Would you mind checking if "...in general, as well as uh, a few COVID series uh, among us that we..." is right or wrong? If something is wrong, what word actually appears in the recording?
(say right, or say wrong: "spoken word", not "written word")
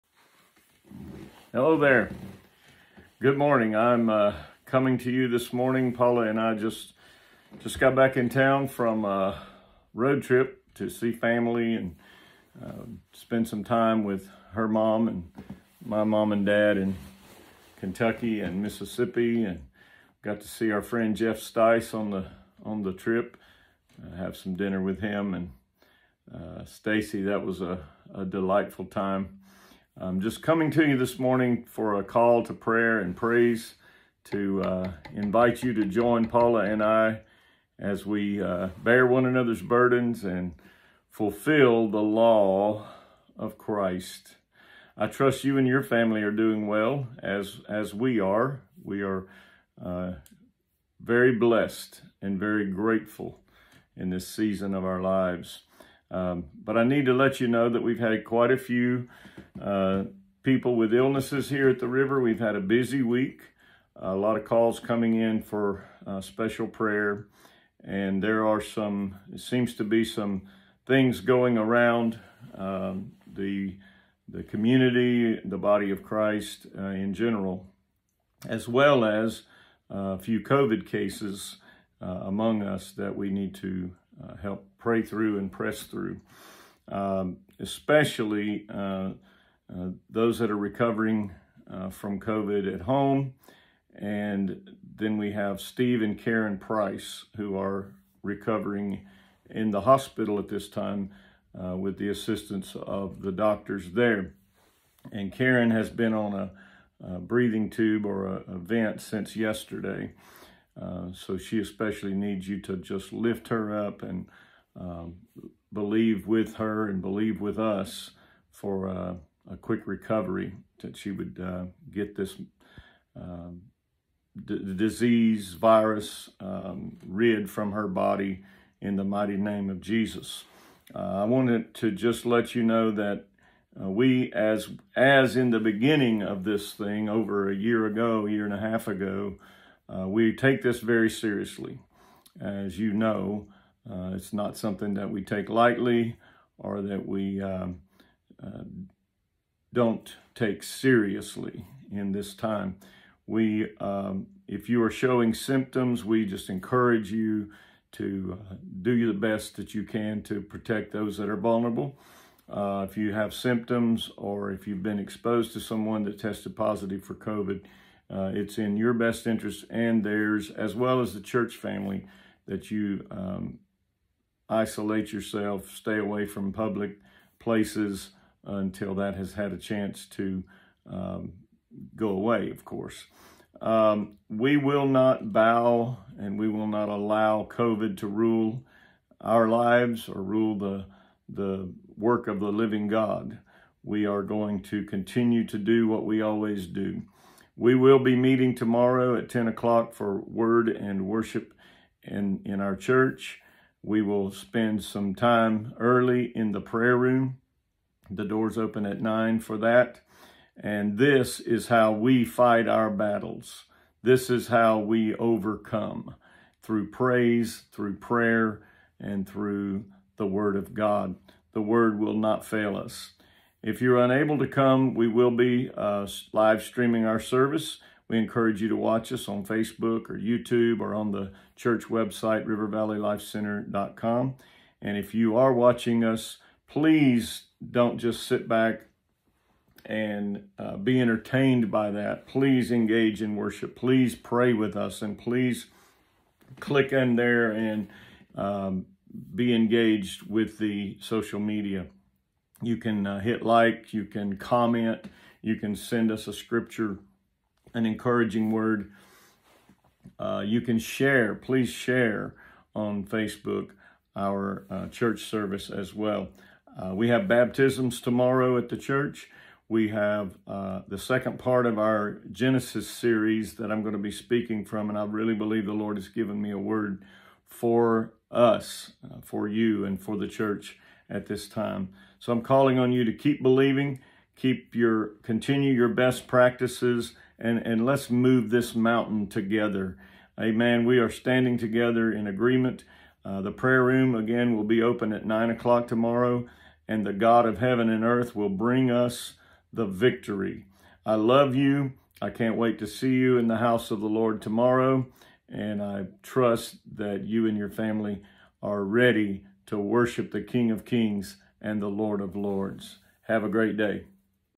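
wrong: "cases", not "series".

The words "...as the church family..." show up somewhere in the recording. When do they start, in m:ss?
2:50.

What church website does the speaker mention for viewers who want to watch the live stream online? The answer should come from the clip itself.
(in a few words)
rivervalleylifecenter.com.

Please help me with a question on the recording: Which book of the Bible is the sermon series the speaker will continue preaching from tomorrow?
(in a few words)
Genesis.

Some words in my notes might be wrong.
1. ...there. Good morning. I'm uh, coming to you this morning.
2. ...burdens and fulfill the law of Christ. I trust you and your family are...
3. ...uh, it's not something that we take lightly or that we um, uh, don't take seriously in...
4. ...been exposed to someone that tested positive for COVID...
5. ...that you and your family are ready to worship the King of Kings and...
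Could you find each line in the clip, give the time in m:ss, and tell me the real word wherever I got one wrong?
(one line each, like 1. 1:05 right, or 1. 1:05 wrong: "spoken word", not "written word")
1. 0:01 right
2. 0:39 right
3. 2:23 right
4. 2:44 right
5. 5:06 right.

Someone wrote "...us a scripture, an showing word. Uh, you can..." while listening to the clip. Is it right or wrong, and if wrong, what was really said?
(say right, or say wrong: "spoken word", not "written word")
wrong: "encouraging", not "showing".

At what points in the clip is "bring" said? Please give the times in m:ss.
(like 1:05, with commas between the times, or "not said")
4:58.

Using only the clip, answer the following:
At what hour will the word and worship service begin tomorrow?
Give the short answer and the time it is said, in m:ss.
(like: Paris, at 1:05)
10 o'clock, at 3:19.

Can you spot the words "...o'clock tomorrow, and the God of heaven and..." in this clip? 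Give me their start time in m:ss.
4:55.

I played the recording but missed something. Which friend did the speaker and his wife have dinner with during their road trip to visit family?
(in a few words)
Jeff Stice.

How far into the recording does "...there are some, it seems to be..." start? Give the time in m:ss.
1:08.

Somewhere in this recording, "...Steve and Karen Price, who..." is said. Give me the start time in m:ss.
1:35.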